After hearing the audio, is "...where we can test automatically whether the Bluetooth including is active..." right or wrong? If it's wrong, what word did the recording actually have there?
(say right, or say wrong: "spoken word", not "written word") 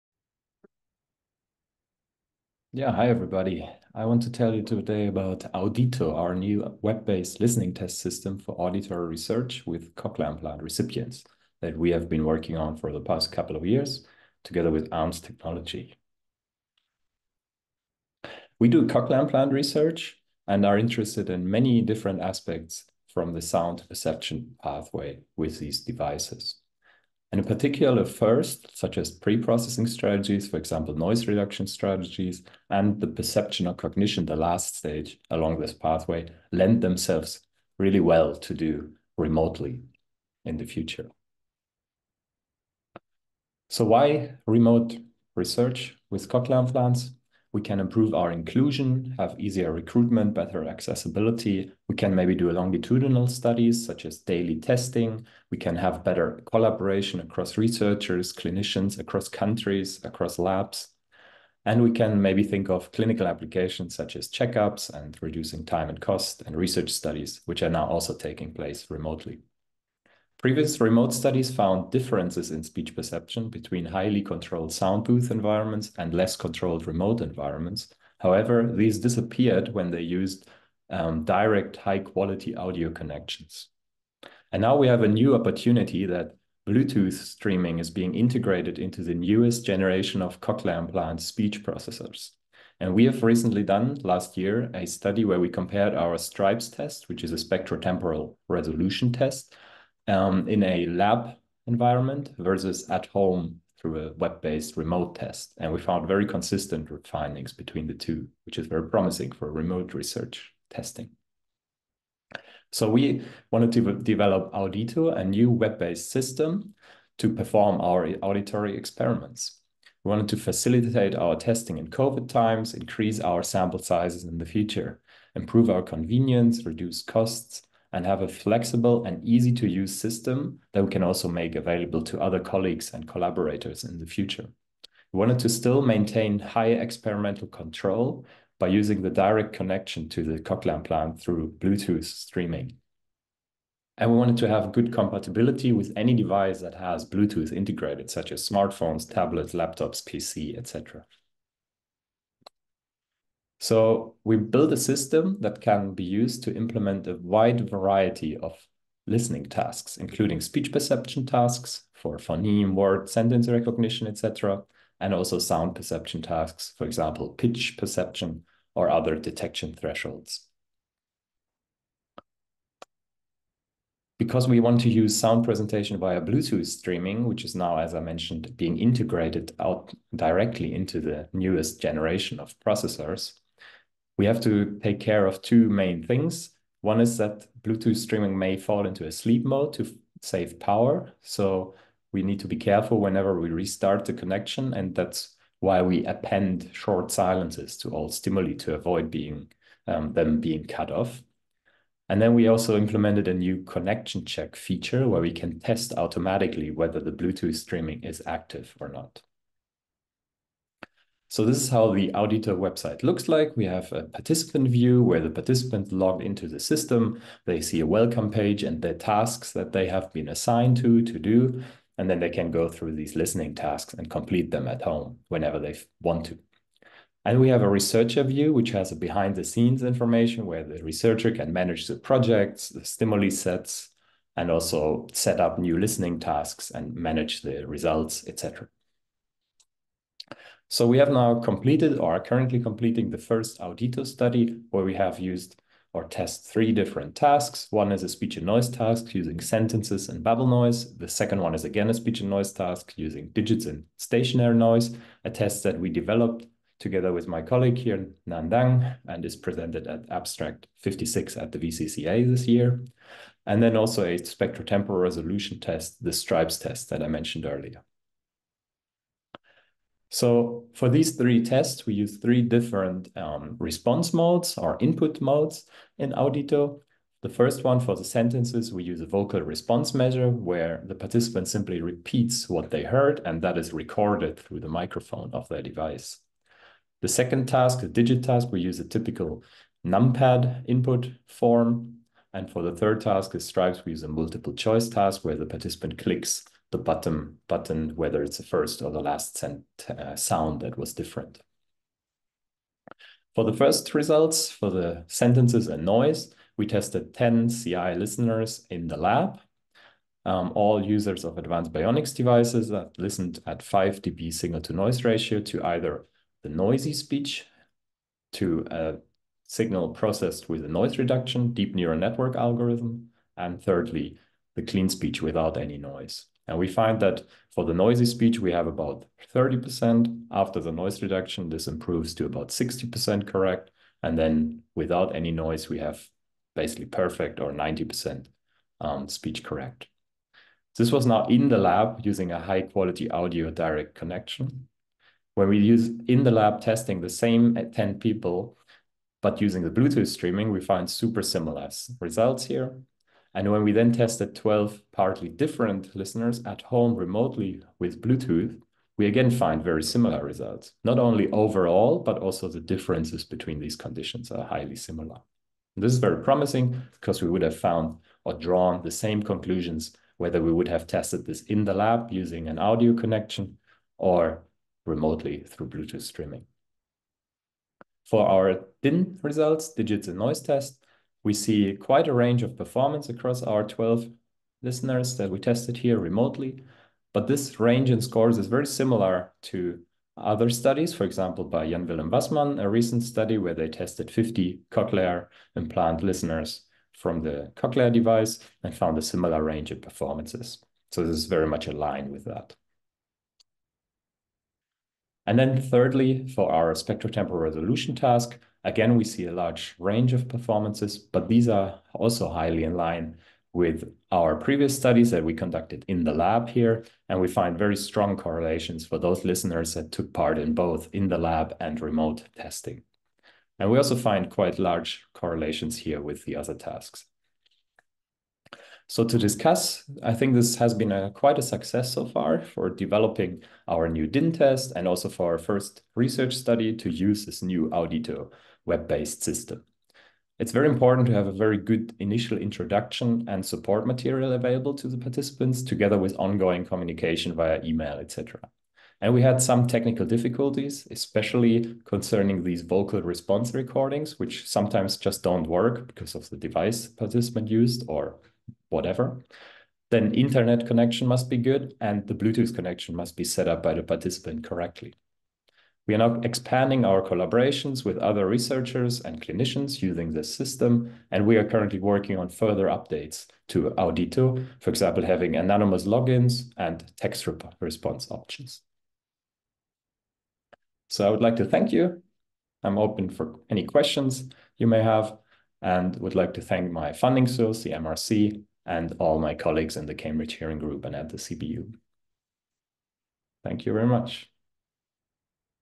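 wrong: "streaming", not "including".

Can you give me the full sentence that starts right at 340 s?
This was now in the lab using a high quality audio direct connection.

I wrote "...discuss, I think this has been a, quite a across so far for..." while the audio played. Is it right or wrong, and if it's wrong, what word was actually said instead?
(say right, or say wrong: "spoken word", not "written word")
wrong: "success", not "across".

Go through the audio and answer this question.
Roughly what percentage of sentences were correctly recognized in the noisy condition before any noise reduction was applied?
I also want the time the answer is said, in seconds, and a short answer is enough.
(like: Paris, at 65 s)
30%, at 329 s.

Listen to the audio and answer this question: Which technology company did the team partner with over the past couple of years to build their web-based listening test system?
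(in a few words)
ARMS technology.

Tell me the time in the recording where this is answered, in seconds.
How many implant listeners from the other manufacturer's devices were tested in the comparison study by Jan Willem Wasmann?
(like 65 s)
394 s.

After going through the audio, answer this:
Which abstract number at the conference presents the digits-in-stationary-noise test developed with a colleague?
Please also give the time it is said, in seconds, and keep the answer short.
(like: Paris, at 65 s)
56, at 260 s.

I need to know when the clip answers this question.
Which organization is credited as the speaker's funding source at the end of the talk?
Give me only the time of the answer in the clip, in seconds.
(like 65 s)
487 s.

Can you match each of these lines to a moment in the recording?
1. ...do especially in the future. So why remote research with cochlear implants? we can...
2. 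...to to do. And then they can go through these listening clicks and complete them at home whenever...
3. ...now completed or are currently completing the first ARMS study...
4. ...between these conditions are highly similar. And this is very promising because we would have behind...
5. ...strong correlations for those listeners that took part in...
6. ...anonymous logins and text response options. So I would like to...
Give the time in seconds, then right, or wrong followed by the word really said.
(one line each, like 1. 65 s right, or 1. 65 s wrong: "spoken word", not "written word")
1. 38 s wrong: "remotely", not "especially"
2. 220 s wrong: "tasks", not "clicks"
3. 241 s wrong: "Audito", not "ARMS"
4. 363 s wrong: "found", not "behind"
5. 417 s right
6. 475 s right.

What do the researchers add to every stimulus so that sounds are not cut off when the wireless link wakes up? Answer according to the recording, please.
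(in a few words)
short silences.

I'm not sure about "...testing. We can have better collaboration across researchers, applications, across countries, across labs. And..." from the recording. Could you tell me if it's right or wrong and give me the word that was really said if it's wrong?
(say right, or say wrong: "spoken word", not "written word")
wrong: "clinicians", not "applications".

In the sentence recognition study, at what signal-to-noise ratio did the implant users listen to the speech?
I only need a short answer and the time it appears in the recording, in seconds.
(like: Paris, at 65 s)
5 dB, at 313 s.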